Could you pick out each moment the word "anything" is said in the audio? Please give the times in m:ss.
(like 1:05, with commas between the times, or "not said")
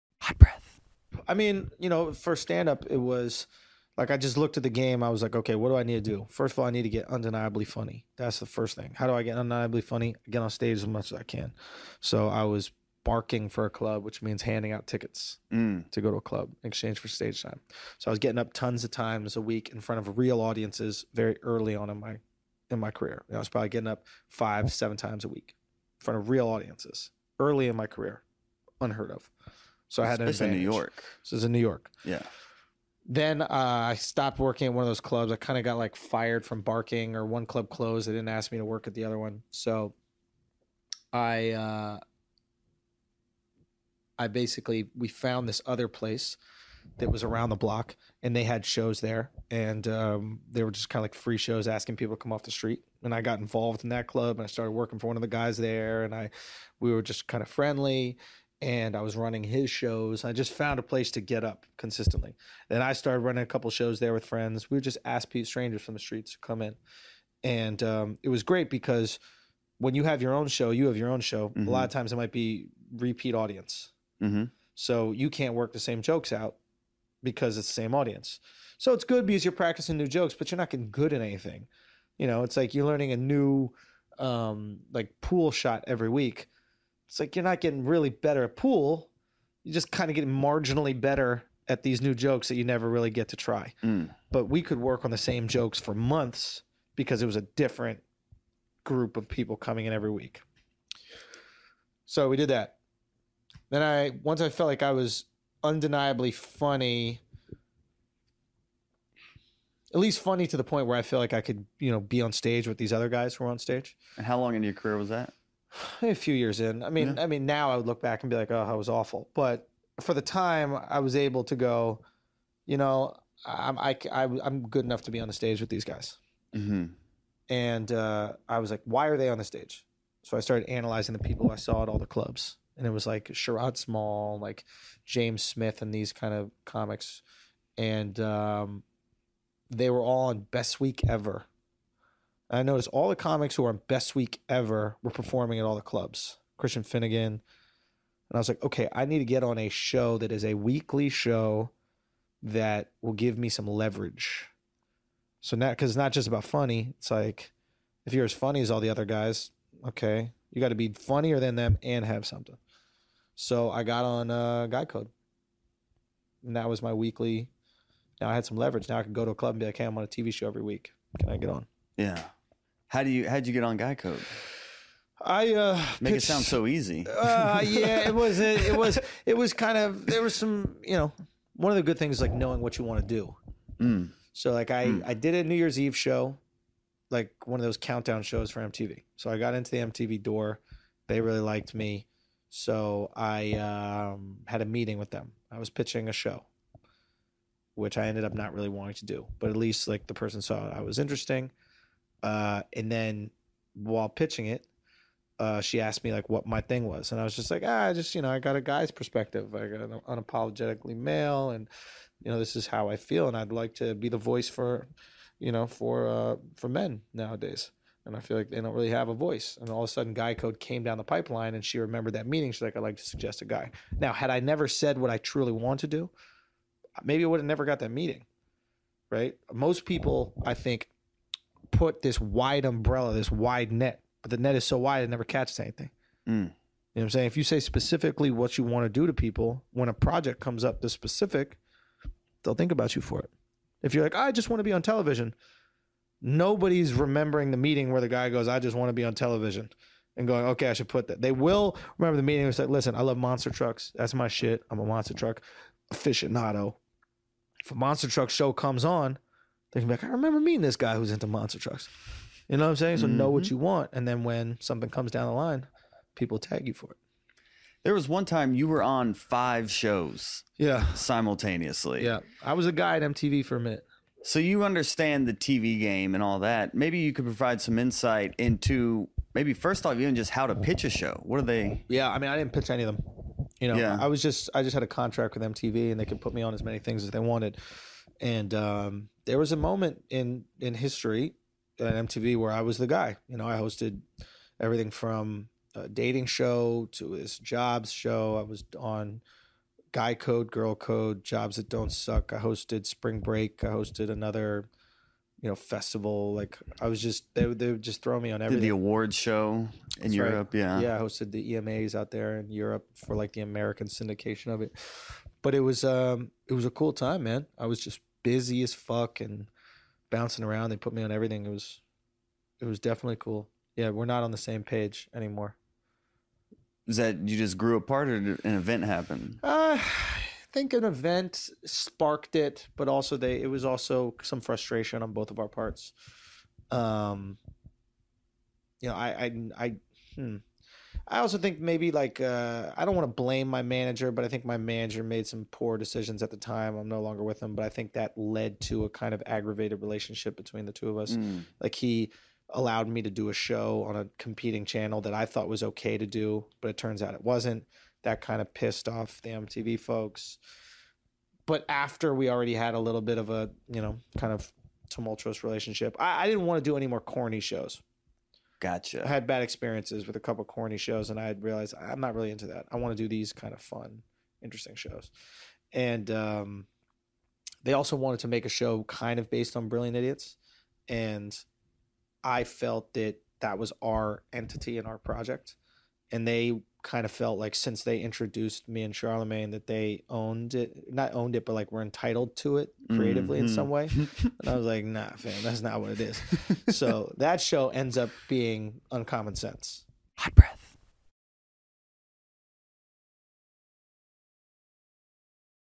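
1:21, 3:55.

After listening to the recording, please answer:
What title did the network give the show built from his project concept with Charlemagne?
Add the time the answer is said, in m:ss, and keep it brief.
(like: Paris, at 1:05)
Uncommon Sense, at 6:38.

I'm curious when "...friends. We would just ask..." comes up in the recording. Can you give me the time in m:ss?
1:04.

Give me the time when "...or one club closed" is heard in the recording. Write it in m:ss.
0:37.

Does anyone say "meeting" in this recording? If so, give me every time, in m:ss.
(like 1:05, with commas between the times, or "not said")
3:14, 3:42, 3:47, 4:07, 4:12, 4:20.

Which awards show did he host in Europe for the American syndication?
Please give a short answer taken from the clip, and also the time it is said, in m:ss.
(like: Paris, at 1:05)
EMAs, at 5:11.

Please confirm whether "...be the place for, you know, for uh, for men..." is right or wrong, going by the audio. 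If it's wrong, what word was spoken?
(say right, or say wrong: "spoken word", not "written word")
wrong: "voice", not "place".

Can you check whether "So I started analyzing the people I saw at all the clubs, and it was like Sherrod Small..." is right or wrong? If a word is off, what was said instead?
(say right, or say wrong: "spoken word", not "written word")
right.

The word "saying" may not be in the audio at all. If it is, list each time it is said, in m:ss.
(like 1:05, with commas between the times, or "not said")
3:57, 4:22.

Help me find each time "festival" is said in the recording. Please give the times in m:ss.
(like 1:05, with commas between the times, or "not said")
5:05.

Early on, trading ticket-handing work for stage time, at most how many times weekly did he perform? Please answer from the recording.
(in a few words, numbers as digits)
7.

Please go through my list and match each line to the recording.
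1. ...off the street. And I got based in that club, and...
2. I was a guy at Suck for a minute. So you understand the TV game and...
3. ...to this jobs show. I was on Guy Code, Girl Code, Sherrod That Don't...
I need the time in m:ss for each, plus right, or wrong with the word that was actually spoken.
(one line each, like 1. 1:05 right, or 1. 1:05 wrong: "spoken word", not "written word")
1. 0:52 wrong: "involved", not "based"
2. 4:32 wrong: "MTV", not "Suck"
3. 4:56 wrong: "Jobs", not "Sherrod".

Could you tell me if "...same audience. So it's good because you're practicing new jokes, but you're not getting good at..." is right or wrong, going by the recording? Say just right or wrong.
right.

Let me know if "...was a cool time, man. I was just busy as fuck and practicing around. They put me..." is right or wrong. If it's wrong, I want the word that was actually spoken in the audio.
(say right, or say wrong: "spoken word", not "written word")
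wrong: "bouncing", not "practicing".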